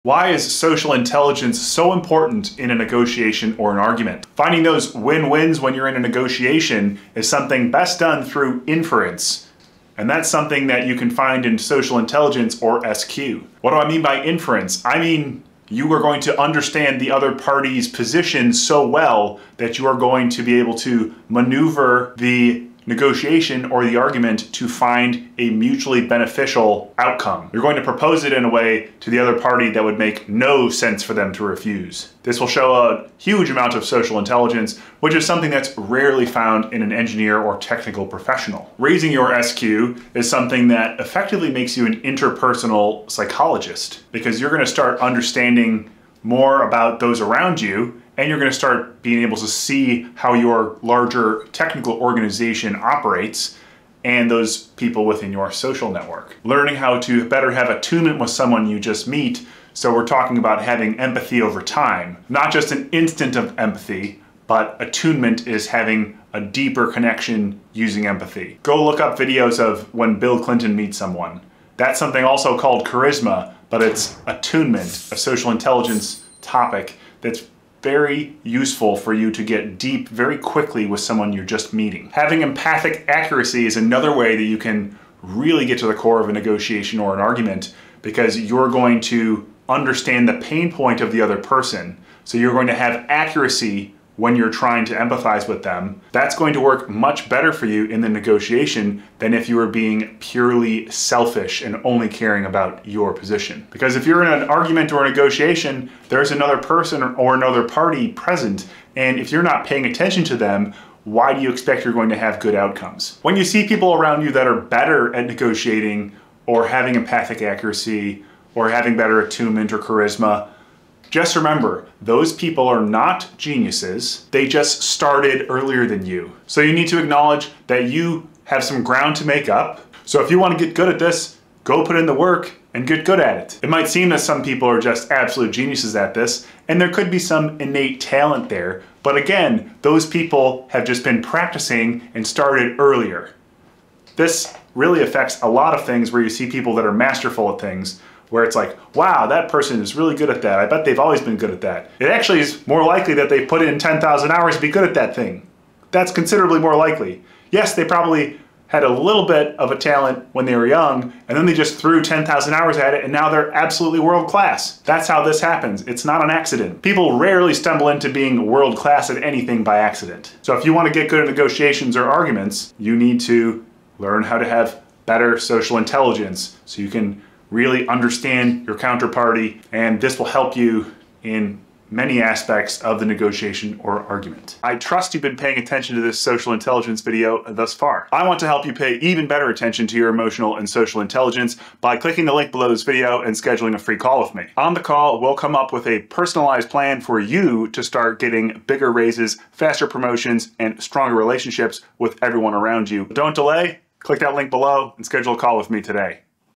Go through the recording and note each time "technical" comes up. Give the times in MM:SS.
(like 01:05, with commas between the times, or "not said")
00:37, 00:51.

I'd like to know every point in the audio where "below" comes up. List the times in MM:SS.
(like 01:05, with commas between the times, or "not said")
03:12, 03:24.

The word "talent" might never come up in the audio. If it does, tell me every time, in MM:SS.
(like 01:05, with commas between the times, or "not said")
02:17, 02:39.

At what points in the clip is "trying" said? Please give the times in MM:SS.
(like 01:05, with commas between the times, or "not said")
01:34.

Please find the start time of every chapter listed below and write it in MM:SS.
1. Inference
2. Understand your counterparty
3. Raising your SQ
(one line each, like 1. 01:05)
1. 00:13
2. 01:43
3. 00:38.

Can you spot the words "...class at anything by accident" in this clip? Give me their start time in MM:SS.
02:48.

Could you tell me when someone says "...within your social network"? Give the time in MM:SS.
00:55.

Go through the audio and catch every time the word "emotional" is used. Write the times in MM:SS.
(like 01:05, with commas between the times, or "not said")
03:10.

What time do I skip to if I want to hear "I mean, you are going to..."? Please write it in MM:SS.
00:14.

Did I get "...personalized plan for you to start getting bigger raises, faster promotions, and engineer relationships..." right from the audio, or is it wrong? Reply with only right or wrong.
wrong.